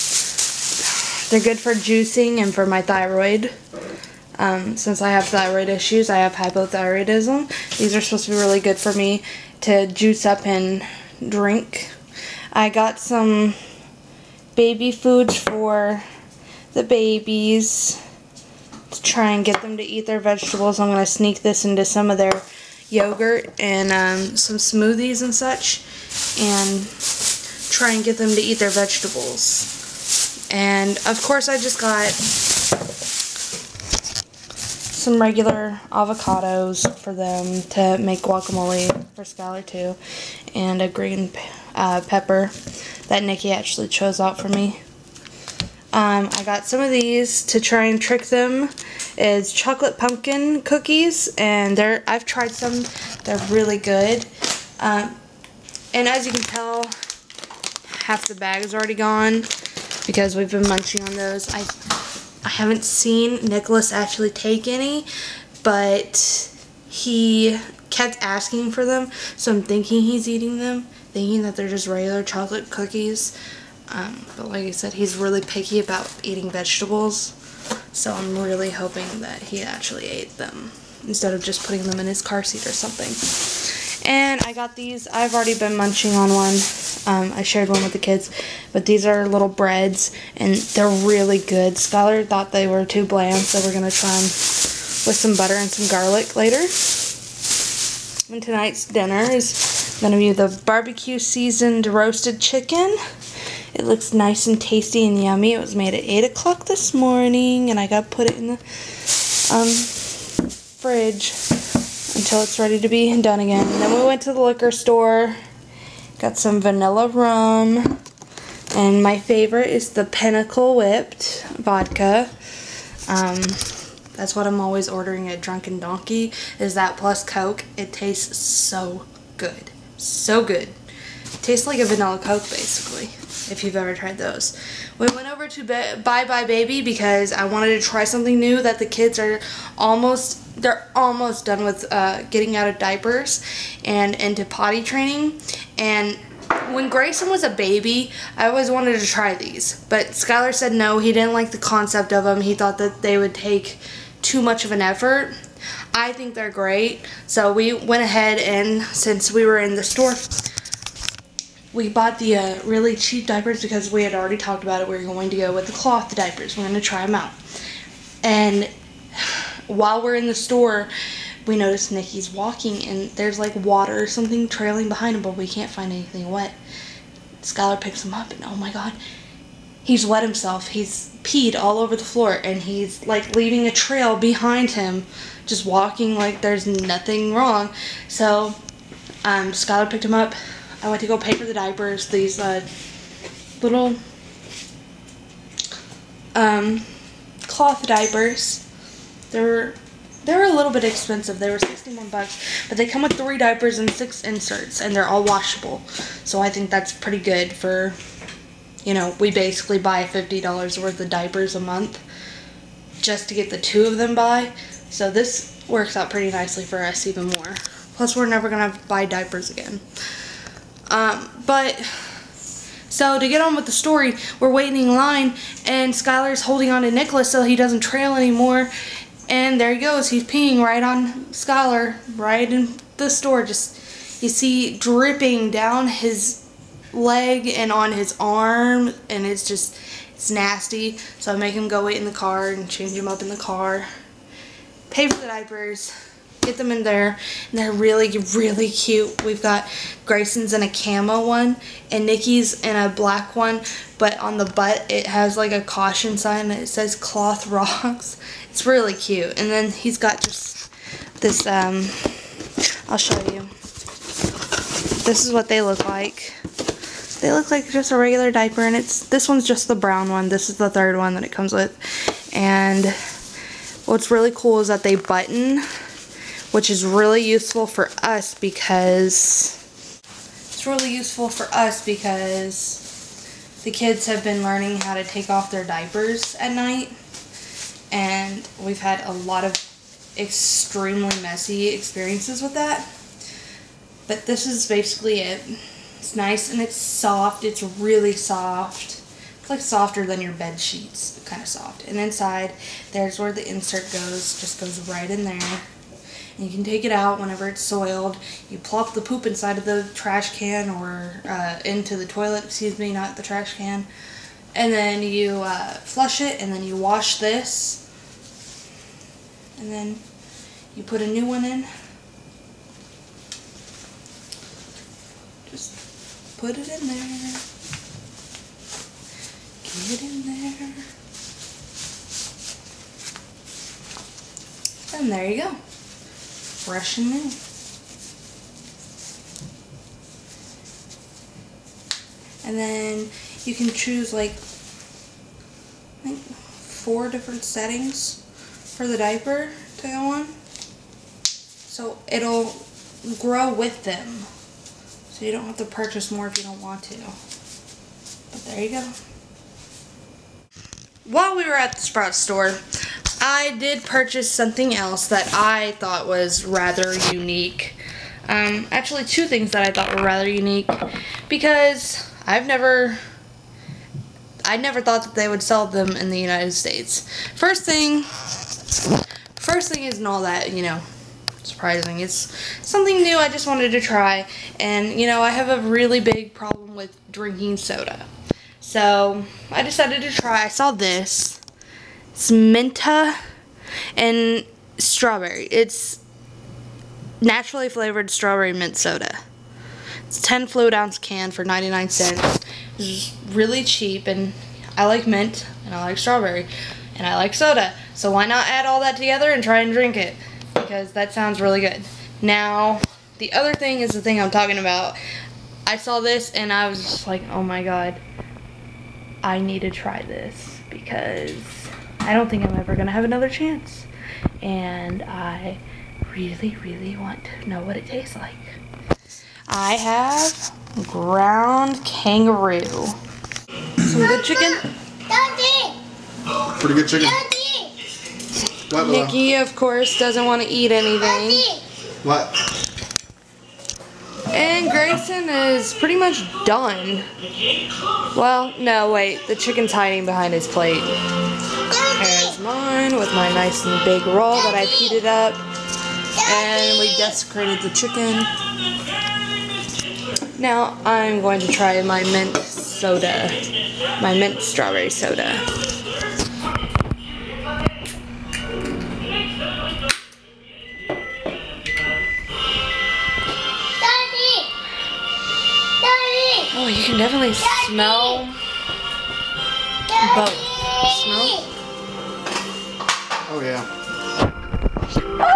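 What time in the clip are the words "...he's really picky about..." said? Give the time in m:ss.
1:14.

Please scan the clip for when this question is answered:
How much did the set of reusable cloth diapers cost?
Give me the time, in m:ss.
3:21.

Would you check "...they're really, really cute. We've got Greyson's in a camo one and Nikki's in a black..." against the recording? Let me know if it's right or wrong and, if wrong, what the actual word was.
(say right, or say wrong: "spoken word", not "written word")
right.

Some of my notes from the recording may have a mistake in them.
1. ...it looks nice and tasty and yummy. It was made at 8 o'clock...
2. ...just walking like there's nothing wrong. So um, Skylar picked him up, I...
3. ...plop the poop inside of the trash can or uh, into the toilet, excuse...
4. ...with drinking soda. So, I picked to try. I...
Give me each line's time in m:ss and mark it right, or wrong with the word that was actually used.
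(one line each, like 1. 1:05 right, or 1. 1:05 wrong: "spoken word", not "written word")
1. 1:43 right
2. 3:05 right
3. 5:08 right
4. 6:26 wrong: "decided", not "picked".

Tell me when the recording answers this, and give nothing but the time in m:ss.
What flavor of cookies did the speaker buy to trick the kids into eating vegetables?
0:49.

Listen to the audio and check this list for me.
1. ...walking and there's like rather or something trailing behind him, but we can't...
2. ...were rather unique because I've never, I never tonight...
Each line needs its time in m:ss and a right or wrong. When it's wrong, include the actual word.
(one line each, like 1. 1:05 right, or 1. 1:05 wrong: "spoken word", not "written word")
1. 2:52 wrong: "water", not "rather"
2. 6:09 wrong: "thought", not "tonight".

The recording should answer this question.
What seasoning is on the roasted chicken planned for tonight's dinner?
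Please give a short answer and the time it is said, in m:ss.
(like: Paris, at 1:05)
Barbecue, at 1:40.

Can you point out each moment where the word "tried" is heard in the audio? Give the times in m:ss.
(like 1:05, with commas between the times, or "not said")
0:52, 2:13.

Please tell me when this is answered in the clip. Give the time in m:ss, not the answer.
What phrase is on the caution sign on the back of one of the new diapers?
4:16.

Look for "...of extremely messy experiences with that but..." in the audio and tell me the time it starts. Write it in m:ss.
4:49.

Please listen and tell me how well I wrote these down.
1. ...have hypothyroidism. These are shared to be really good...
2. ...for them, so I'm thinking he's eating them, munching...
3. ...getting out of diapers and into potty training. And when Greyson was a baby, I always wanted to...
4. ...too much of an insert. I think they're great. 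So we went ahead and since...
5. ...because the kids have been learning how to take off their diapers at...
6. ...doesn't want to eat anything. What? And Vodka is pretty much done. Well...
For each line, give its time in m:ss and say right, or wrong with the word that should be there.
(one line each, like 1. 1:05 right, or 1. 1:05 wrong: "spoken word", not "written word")
1. 0:06 wrong: "supposed", not "shared"
2. 1:08 wrong: "thinking", not "munching"
3. 2:22 right
4. 2:34 wrong: "effort", not "insert"
5. 4:41 right
6. 7:19 wrong: "Greyson", not "Vodka".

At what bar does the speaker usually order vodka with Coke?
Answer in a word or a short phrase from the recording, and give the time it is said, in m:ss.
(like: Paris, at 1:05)
Drunken Donkey, at 2:05.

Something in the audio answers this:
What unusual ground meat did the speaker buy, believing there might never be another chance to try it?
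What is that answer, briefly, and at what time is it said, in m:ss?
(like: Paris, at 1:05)
Kangaroo, at 7:10.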